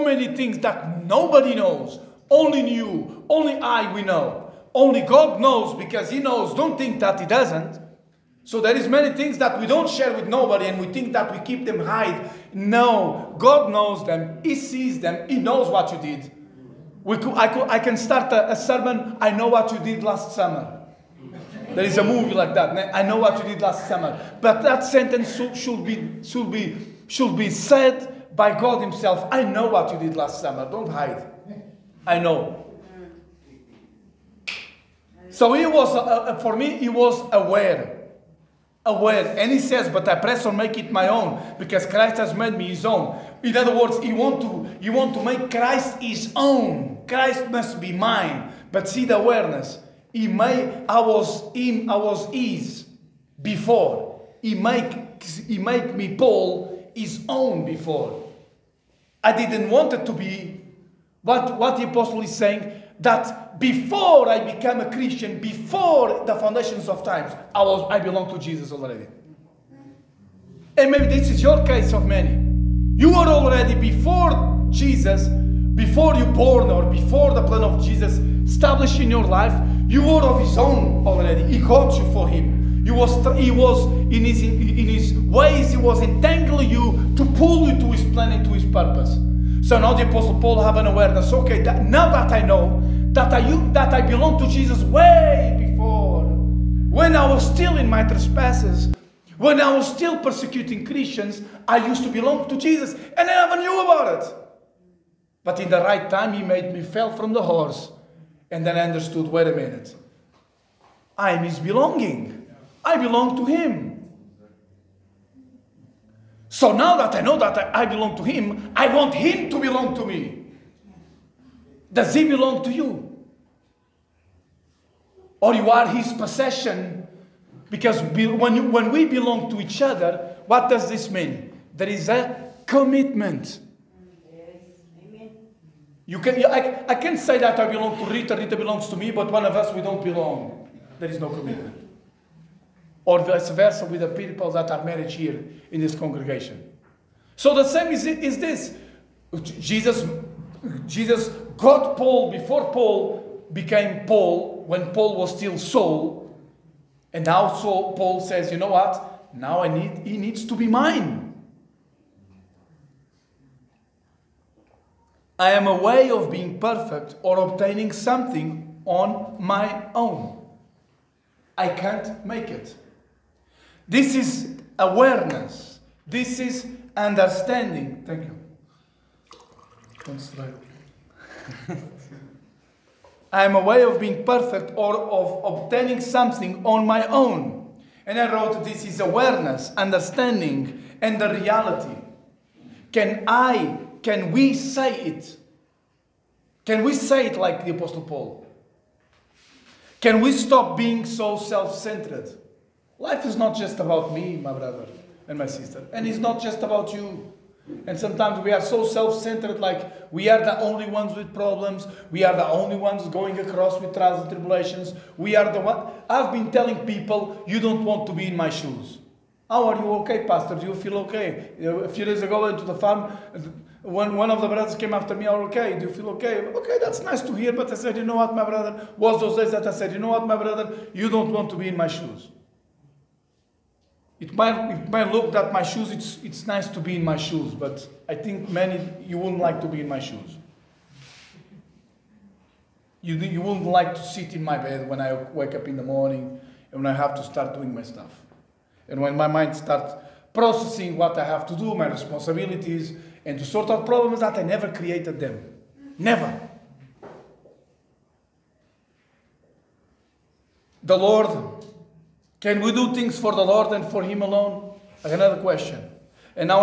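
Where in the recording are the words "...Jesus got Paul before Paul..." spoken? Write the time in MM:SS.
02:30.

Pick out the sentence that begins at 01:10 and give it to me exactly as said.
And maybe this is your case of many.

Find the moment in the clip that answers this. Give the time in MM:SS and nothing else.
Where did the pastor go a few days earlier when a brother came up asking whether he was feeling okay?
03:42.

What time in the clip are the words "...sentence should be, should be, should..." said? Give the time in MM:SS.
00:24.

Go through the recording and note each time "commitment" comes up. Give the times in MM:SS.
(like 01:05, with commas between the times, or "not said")
02:12, 02:21.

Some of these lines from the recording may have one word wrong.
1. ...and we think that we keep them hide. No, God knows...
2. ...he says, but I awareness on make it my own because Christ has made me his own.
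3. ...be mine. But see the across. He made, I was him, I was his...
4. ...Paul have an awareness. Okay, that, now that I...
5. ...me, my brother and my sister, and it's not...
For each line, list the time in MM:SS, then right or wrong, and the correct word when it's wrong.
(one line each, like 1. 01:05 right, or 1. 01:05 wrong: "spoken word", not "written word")
1. 00:10 right
2. 00:39 wrong: "press", not "awareness"
3. 00:47 wrong: "awareness", not "across"
4. 01:30 right
5. 03:24 right.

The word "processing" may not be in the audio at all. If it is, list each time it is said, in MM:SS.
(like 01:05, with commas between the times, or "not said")
04:10.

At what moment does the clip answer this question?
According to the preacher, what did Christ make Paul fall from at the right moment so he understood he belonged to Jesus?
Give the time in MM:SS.
01:47.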